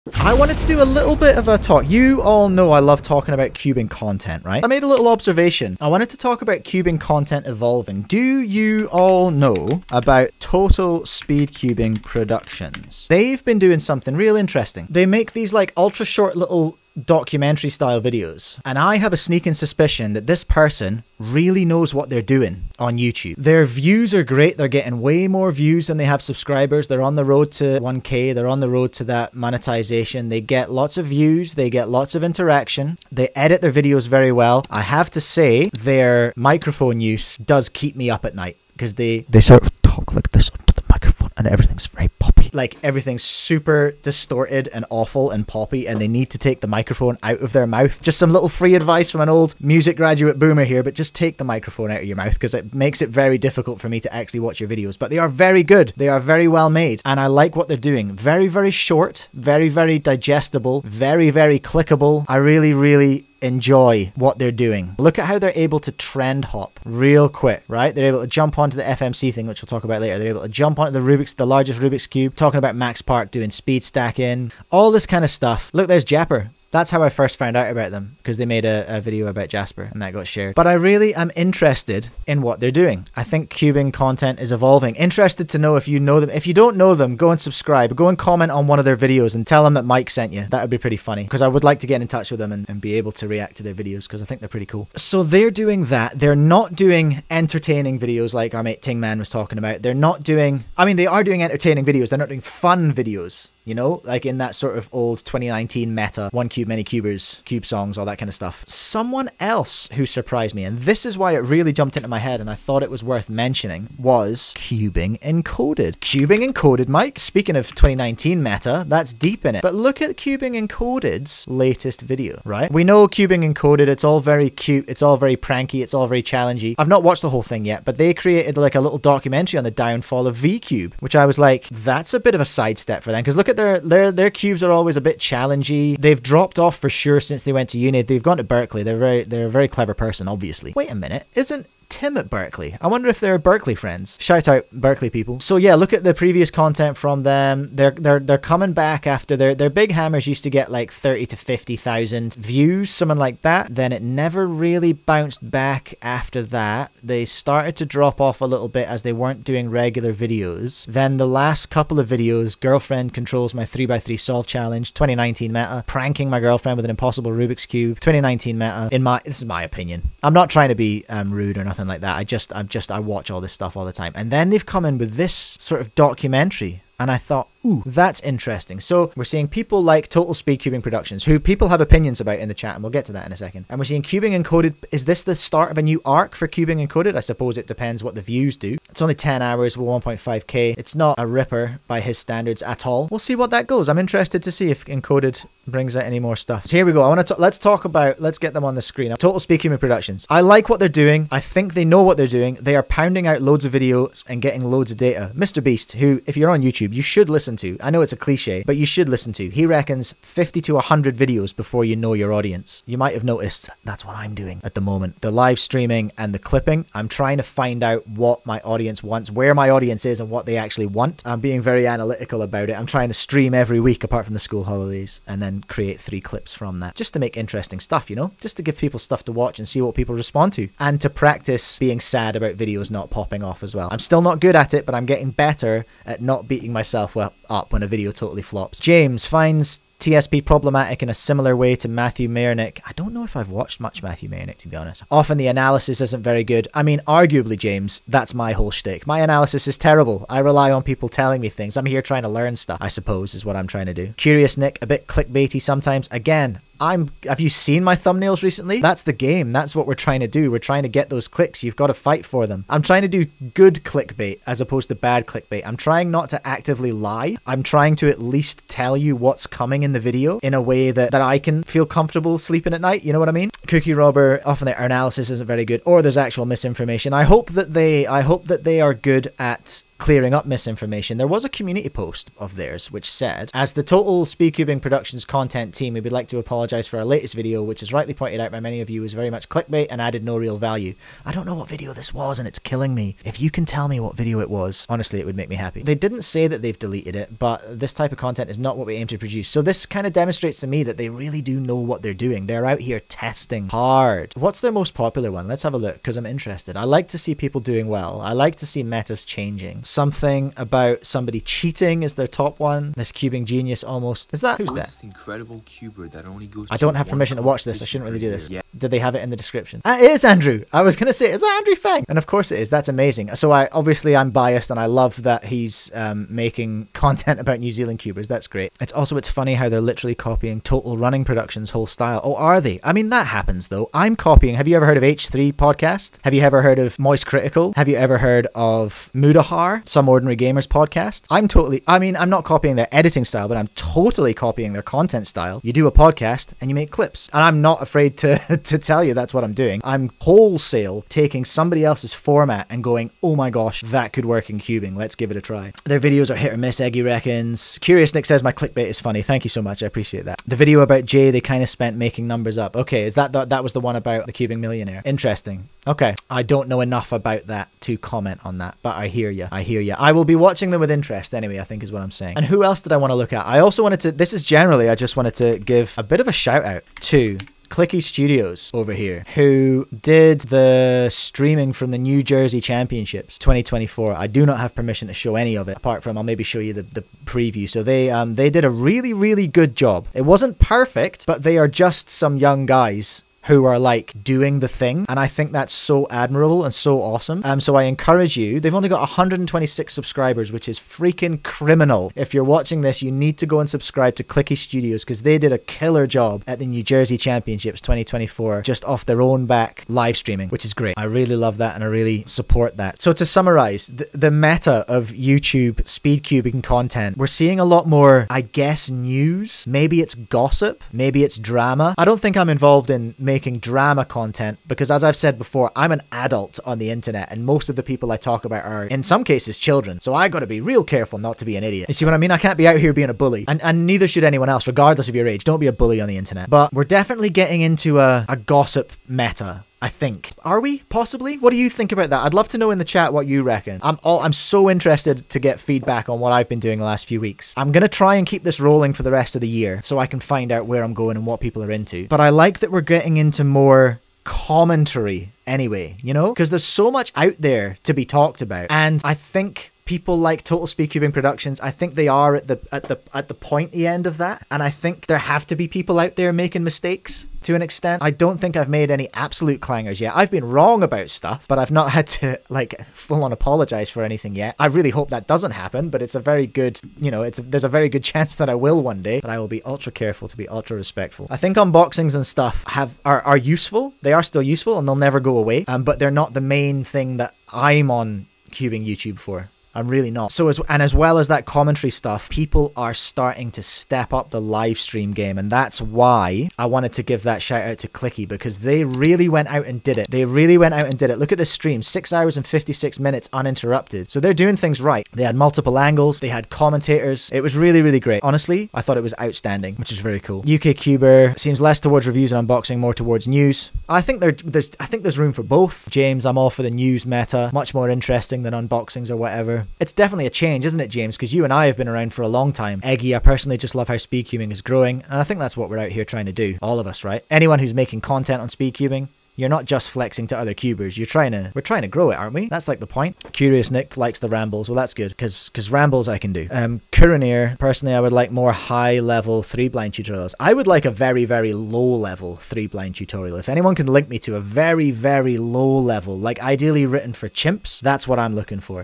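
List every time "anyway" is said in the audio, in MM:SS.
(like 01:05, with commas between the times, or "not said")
06:11, 07:35.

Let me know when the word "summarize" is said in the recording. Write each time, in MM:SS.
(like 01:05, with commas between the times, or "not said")
06:53.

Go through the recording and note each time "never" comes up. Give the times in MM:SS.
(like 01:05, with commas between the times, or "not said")
02:34, 08:04.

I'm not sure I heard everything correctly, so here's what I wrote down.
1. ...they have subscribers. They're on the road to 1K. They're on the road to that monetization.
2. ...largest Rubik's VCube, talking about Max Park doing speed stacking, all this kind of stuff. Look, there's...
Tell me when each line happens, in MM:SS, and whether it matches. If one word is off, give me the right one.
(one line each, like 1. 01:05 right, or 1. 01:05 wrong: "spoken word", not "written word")
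1. 00:25 right
2. 01:11 wrong: "Cube", not "VCube".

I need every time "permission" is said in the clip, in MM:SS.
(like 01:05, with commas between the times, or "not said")
05:17, 06:24.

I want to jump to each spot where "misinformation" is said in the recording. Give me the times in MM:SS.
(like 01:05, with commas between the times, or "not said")
04:36, 04:40.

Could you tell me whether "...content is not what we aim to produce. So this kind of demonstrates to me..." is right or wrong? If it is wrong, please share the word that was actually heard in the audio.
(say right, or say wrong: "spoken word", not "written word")
right.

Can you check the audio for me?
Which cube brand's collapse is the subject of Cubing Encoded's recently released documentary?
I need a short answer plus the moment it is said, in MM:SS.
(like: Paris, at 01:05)
VCube, at 02:09.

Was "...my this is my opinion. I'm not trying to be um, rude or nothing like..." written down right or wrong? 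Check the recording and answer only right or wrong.
right.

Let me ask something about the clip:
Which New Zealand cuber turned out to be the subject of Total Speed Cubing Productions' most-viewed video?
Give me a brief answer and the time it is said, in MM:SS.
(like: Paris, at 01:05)
Andrew Fang, at 05:21.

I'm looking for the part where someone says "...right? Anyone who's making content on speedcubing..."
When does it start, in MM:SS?
08:47.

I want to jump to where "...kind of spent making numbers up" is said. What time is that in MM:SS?
06:01.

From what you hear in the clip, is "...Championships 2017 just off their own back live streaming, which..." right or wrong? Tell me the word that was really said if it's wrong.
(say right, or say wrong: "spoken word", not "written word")
wrong: "2024", not "2017".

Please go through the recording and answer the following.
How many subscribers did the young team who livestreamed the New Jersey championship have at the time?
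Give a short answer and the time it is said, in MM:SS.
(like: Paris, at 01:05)
126, at 06:39.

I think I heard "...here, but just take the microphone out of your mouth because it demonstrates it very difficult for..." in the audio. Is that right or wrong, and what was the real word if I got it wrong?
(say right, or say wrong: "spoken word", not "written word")
wrong: "makes", not "demonstrates".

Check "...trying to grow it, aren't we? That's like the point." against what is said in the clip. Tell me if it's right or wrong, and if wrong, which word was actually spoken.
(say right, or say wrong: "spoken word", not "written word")
right.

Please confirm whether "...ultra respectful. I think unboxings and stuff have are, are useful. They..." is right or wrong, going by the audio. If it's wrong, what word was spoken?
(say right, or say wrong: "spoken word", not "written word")
right.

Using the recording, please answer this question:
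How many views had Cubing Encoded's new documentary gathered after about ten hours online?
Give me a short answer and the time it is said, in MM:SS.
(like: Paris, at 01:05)
1.5k, at 03:09.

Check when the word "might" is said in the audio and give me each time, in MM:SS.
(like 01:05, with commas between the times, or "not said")
03:32.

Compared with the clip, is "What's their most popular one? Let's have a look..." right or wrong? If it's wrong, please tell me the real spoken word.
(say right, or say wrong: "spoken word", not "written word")
right.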